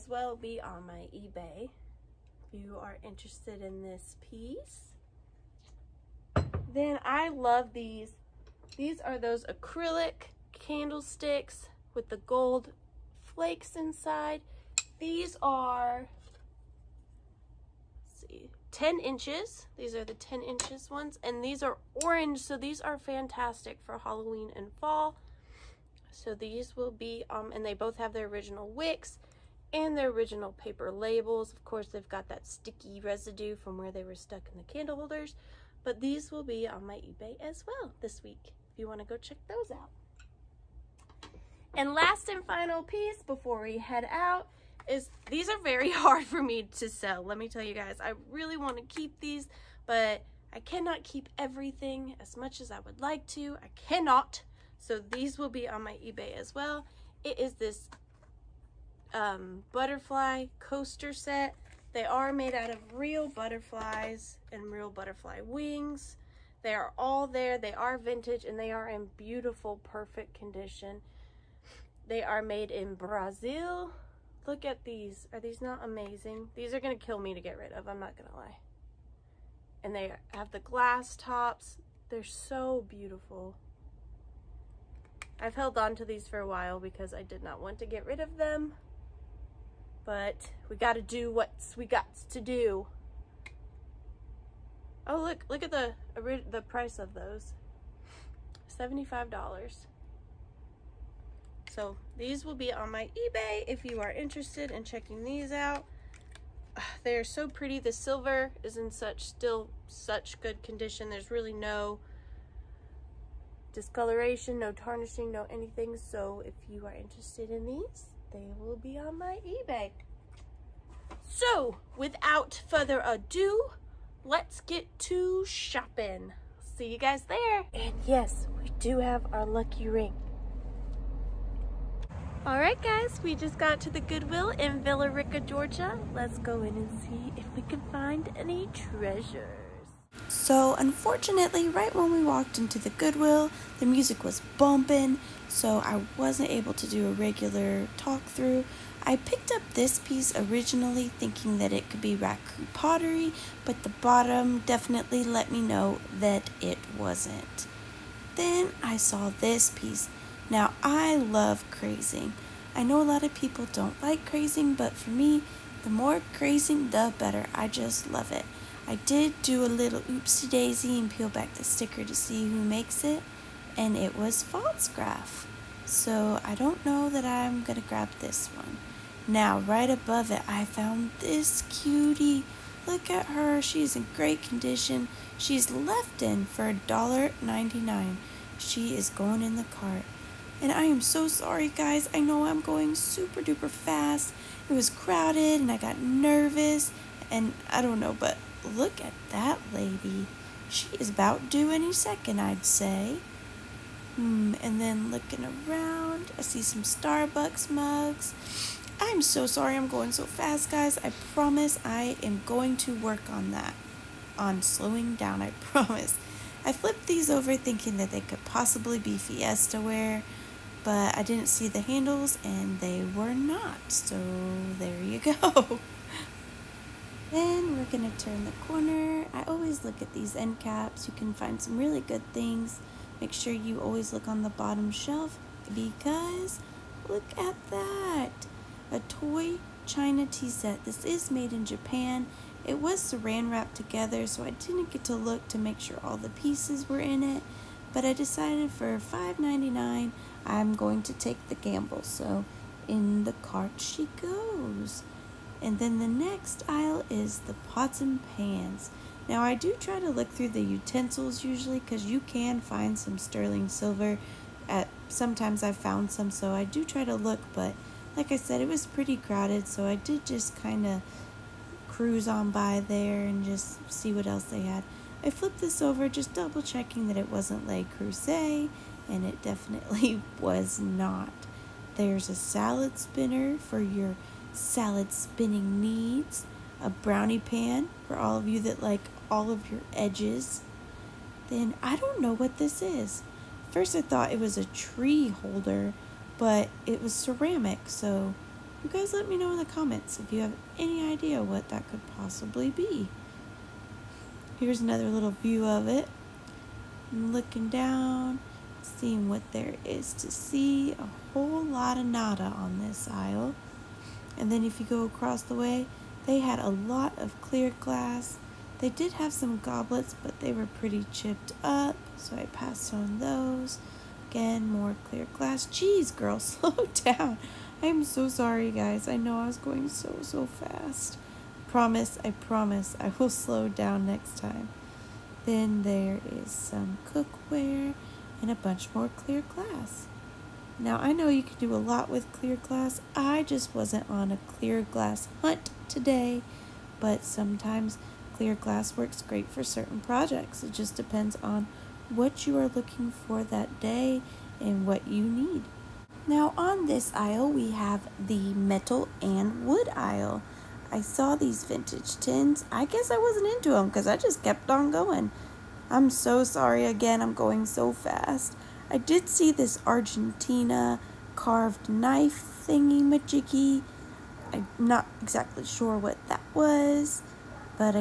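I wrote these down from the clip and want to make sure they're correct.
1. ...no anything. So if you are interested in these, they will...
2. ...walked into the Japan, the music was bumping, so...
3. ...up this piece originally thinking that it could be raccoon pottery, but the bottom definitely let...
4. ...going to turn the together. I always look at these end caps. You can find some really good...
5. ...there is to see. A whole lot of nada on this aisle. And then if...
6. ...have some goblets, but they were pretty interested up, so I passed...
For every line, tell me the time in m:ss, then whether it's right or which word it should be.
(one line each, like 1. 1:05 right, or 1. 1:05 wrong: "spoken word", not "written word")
1. 1:55 right
2. 2:22 wrong: "Goodwill", not "Japan"
3. 2:29 right
4. 3:47 wrong: "corner", not "together"
5. 5:09 right
6. 5:19 wrong: "chipped", not "interested".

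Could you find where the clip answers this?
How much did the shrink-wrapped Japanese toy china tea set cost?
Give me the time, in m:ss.
4:08.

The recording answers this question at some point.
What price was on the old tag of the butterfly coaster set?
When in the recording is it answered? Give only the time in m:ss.
1:38.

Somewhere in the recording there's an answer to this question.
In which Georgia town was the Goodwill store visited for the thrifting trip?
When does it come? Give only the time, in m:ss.
2:14.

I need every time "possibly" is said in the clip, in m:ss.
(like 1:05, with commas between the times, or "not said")
3:38, 5:02.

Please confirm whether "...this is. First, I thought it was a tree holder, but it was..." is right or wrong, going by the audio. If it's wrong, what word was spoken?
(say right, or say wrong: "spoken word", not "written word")
right.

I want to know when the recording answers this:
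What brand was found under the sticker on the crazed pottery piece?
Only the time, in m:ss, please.
2:54.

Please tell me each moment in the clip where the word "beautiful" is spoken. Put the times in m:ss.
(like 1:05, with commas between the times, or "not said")
1:09, 1:22.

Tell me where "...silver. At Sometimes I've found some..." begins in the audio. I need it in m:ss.
4:23.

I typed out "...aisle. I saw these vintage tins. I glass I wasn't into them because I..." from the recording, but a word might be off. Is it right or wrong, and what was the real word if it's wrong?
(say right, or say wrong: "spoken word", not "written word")
wrong: "guess", not "glass".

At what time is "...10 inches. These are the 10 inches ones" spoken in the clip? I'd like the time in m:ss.
0:18.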